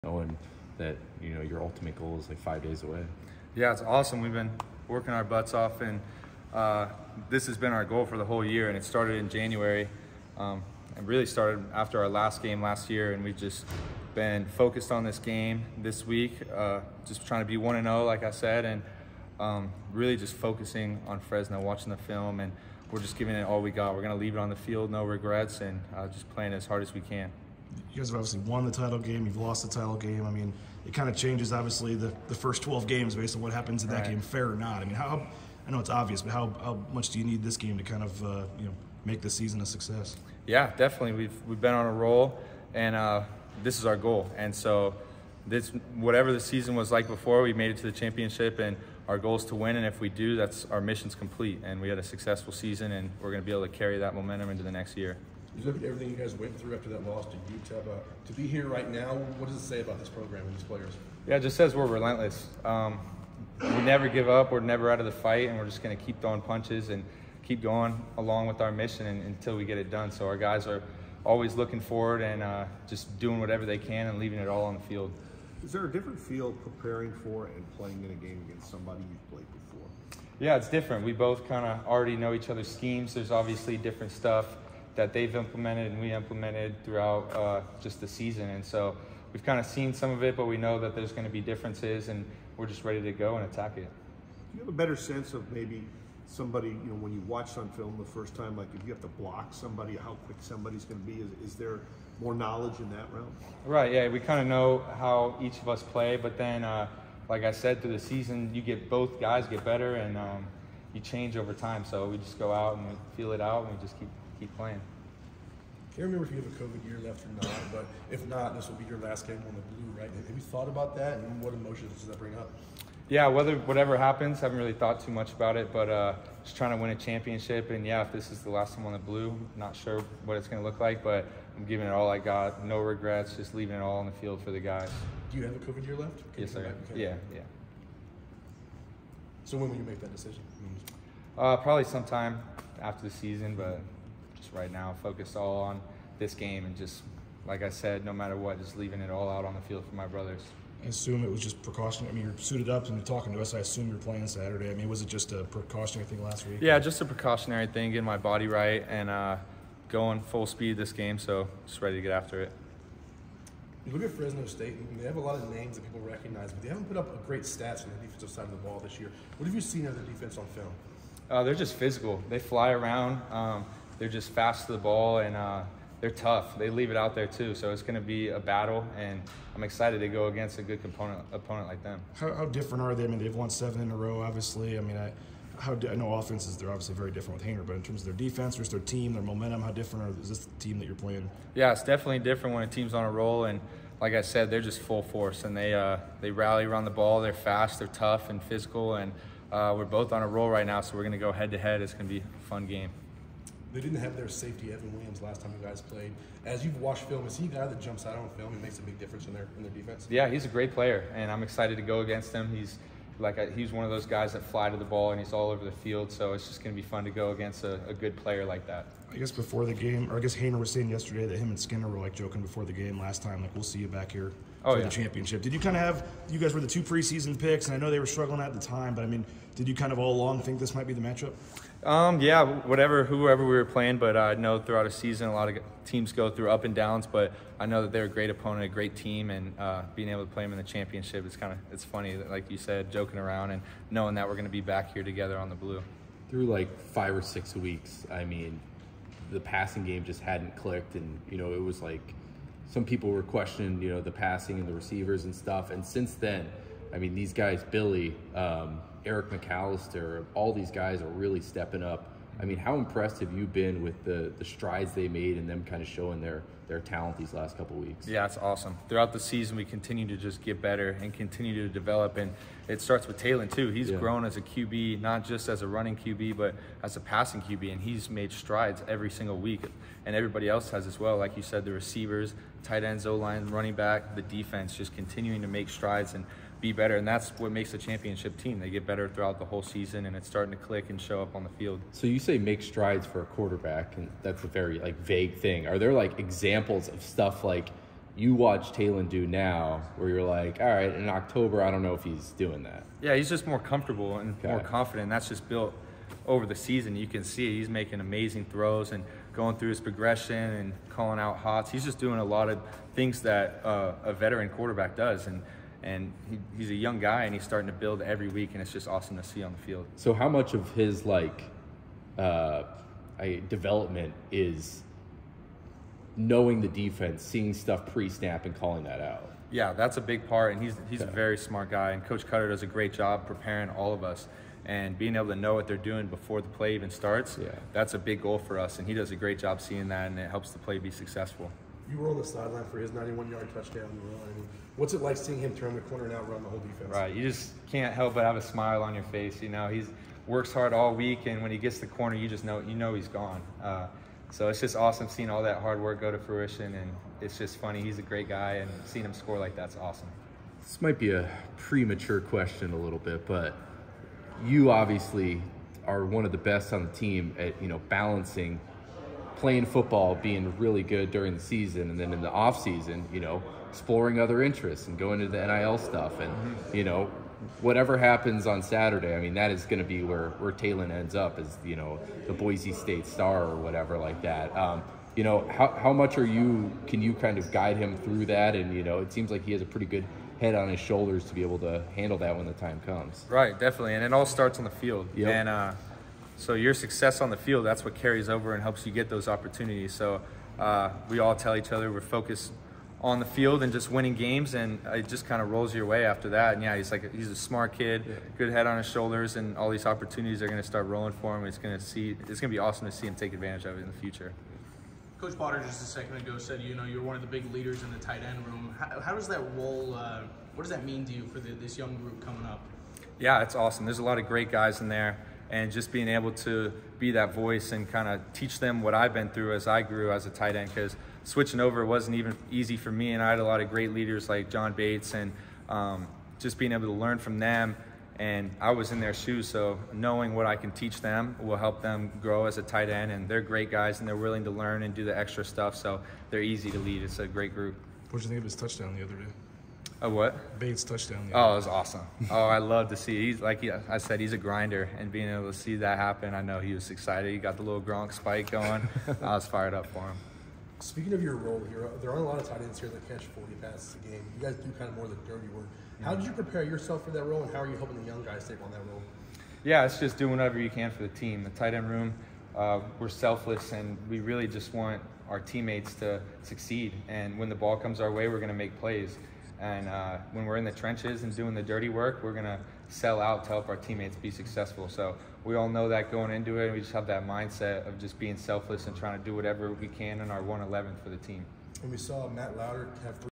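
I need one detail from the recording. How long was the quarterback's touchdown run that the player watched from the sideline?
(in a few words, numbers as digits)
91 yards.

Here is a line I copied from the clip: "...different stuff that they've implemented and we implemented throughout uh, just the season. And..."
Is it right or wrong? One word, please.
right.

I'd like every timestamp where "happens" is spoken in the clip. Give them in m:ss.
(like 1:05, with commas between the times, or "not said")
0:33, 2:03, 6:17, 7:35.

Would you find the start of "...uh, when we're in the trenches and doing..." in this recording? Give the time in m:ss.
7:59.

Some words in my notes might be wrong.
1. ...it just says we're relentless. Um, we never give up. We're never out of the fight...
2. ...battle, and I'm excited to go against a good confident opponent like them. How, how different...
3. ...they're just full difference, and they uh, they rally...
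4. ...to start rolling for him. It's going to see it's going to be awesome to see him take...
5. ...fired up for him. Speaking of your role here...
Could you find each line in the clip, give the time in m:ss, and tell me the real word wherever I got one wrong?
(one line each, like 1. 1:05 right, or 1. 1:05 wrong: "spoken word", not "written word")
1. 1:01 right
2. 2:58 wrong: "component", not "confident"
3. 3:14 wrong: "force", not "difference"
4. 6:50 right
5. 7:39 right.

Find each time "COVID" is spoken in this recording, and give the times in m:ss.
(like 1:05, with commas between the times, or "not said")
1:56, 2:15.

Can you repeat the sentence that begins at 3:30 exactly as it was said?
Yeah, he's a great player, and I'm excited to go against him.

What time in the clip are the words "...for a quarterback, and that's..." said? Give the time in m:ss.
4:53.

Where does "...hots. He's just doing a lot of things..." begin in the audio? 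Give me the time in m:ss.
5:11.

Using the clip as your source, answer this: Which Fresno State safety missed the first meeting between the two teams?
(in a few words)
Evan Williams.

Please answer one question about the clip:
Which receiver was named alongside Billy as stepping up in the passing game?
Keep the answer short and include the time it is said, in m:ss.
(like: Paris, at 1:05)
Eric McAlister, at 4:19.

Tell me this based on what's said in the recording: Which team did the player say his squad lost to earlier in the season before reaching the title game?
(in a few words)
Utah.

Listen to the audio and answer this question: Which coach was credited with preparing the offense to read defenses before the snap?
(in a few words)
Coach Koetter.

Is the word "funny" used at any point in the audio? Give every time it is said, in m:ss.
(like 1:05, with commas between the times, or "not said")
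4:01, 5:57.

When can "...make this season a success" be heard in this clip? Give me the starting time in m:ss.
0:39.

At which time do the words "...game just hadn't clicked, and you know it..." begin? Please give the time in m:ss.
4:09.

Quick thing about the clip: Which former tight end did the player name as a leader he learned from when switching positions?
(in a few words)
John Bates.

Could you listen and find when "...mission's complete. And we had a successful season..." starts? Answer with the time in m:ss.
0:50.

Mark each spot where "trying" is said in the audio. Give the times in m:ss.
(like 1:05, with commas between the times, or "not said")
0:17, 2:06, 8:08.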